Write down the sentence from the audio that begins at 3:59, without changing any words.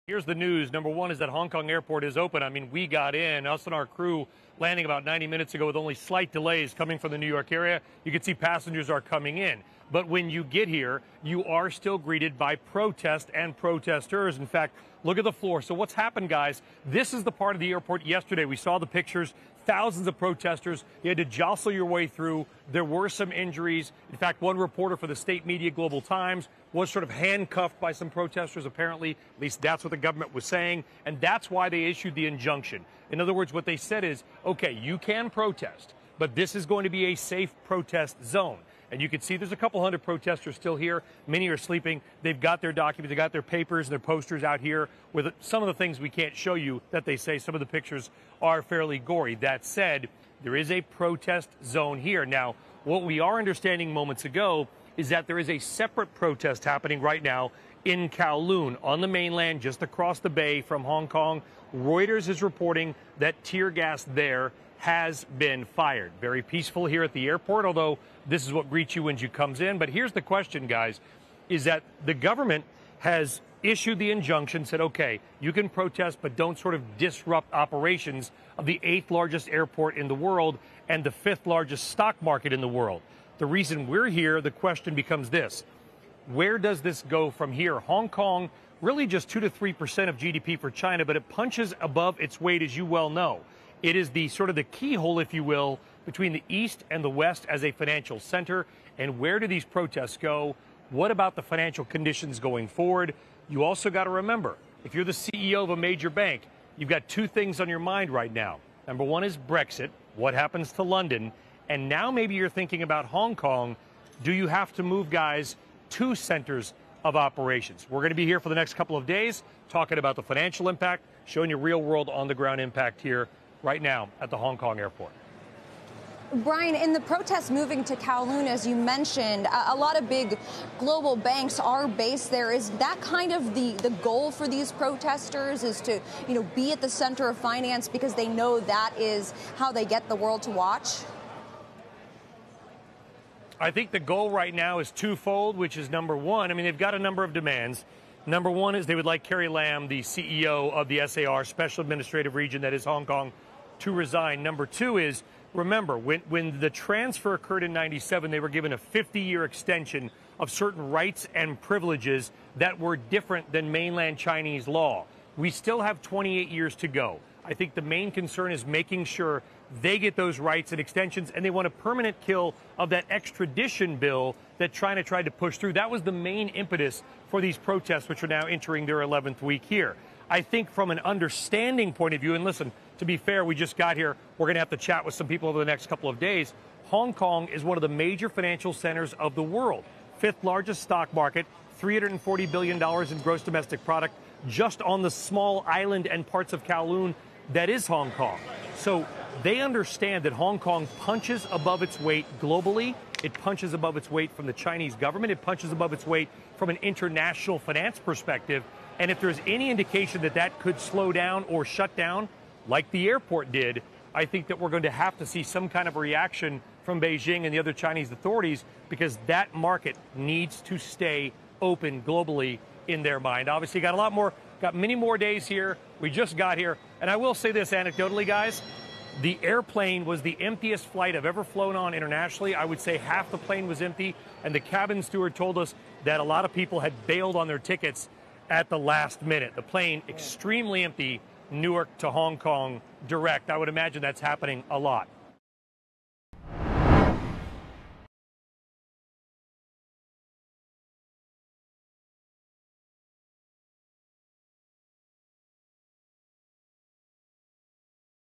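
The plane extremely empty, Newark to Hong Kong direct.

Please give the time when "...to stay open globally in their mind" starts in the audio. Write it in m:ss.
3:40.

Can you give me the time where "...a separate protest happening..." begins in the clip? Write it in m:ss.
0:55.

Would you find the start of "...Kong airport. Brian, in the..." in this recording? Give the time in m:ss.
2:04.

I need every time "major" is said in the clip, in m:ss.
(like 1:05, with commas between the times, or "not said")
1:45, 3:07.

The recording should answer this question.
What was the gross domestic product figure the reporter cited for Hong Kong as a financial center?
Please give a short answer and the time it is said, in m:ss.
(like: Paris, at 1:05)
$340 billion, at 3:11.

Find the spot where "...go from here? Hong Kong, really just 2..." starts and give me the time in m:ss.
1:27.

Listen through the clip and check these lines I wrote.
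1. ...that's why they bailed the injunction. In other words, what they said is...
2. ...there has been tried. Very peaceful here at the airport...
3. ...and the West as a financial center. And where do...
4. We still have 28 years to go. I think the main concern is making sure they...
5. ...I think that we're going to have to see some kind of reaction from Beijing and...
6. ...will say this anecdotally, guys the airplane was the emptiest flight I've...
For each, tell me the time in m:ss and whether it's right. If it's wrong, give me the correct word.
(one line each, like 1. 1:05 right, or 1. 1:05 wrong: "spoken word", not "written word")
1. 0:31 wrong: "issued", not "bailed"
2. 1:04 wrong: "fired", not "tried"
3. 1:36 right
4. 2:45 right
5. 3:34 right
6. 3:47 right.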